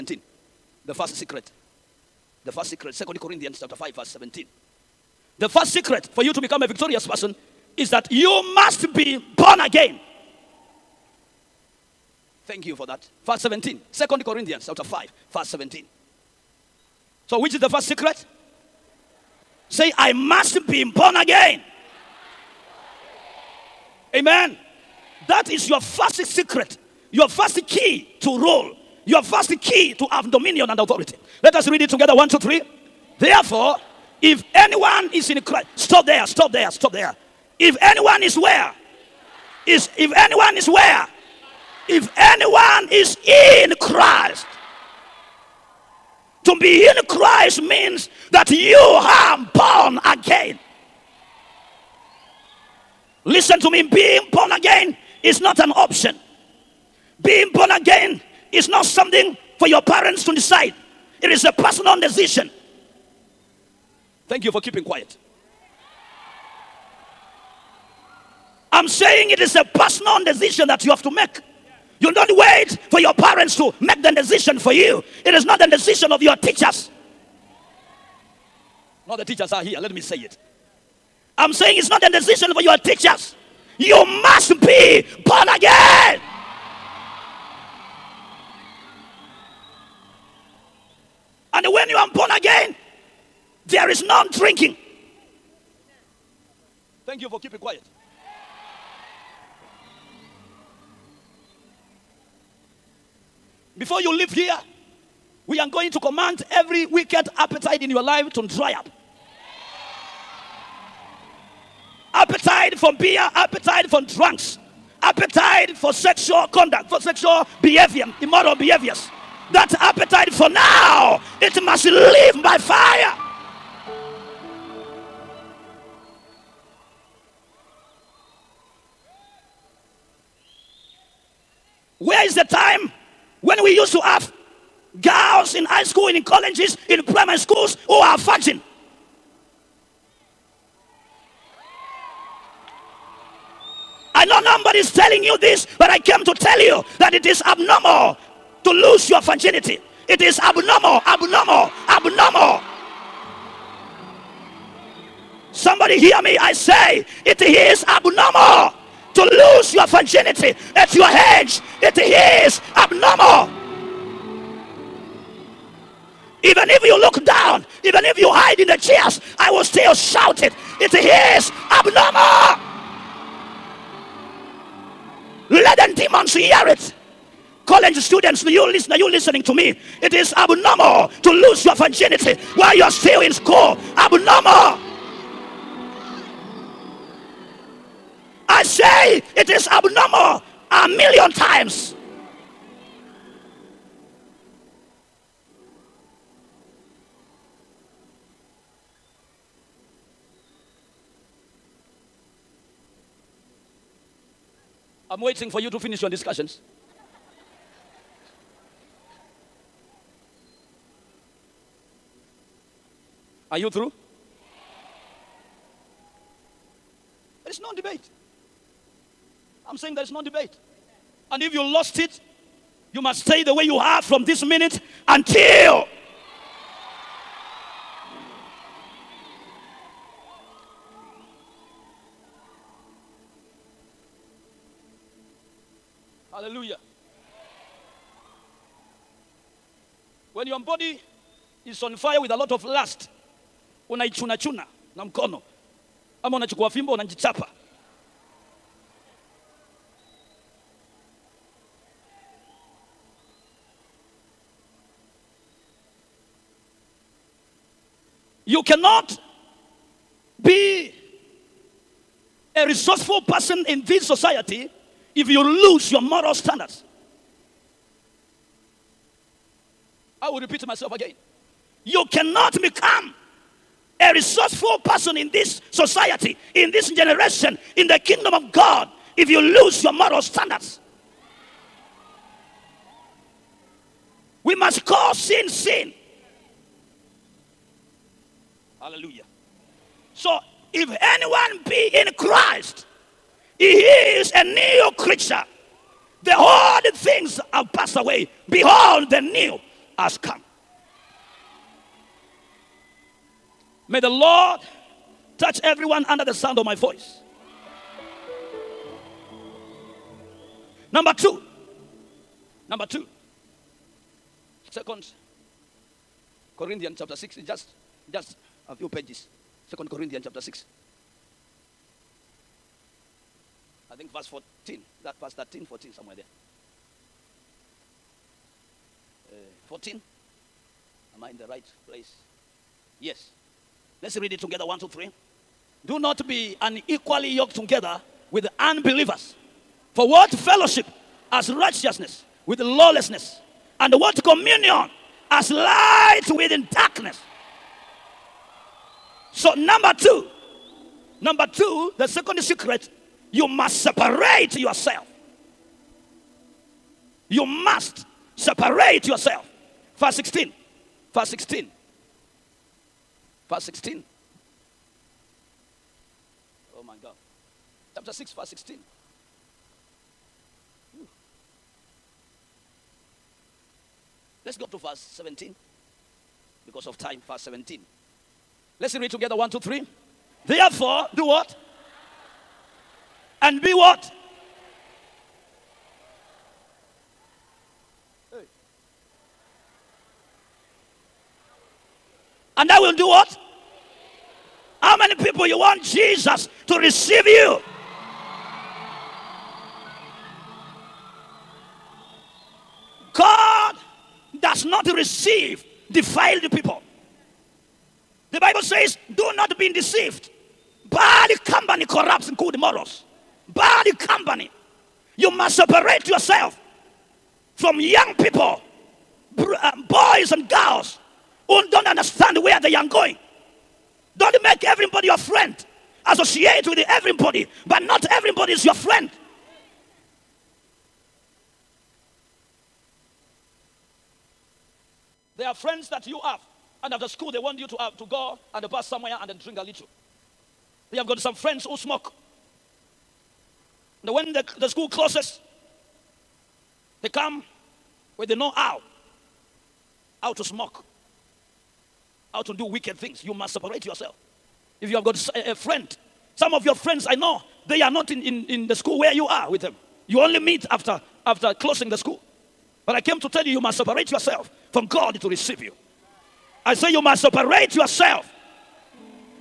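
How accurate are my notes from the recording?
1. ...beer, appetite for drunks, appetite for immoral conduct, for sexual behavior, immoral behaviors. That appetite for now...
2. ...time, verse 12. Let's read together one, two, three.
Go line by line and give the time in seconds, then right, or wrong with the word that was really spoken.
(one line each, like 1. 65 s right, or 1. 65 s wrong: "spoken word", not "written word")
1. 112 s wrong: "sexual", not "immoral"
2. 376 s wrong: "17", not "12".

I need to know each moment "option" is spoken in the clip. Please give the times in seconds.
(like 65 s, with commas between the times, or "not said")
55 s.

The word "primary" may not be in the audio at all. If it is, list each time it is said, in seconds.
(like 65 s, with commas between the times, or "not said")
137 s.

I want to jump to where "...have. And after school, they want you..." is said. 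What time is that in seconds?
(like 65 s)
436 s.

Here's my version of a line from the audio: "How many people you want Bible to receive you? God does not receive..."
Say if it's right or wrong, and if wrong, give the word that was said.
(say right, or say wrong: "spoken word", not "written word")
wrong: "Jesus", not "Bible".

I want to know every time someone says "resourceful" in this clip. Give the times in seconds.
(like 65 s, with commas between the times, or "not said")
262 s, 274 s.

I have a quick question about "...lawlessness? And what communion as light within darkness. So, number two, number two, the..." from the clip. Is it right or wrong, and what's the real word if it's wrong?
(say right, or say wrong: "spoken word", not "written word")
right.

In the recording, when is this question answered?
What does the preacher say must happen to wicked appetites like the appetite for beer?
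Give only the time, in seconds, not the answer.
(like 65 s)
108 s.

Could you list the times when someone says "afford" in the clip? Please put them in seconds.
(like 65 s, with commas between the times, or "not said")
not said.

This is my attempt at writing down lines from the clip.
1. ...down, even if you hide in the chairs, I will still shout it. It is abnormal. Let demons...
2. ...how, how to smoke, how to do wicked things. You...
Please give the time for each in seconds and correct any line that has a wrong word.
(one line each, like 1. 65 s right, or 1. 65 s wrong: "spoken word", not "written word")
1. 167 s right
2. 448 s right.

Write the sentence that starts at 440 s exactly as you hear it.
They have got some friends who smoke.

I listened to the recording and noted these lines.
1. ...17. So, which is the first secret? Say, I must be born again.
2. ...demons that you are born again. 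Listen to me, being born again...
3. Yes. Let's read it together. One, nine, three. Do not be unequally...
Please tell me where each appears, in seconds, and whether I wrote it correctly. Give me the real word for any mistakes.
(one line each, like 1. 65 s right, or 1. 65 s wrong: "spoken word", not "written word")
1. 15 s right
2. 47 s wrong: "means", not "demons"
3. 332 s wrong: "two", not "nine".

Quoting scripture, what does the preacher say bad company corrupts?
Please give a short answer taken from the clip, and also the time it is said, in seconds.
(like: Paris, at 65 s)
Good morals, at 412 s.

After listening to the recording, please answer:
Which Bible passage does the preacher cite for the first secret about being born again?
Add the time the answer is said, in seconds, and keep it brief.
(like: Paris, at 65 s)
2 Corinthians 5:17, at 2 s.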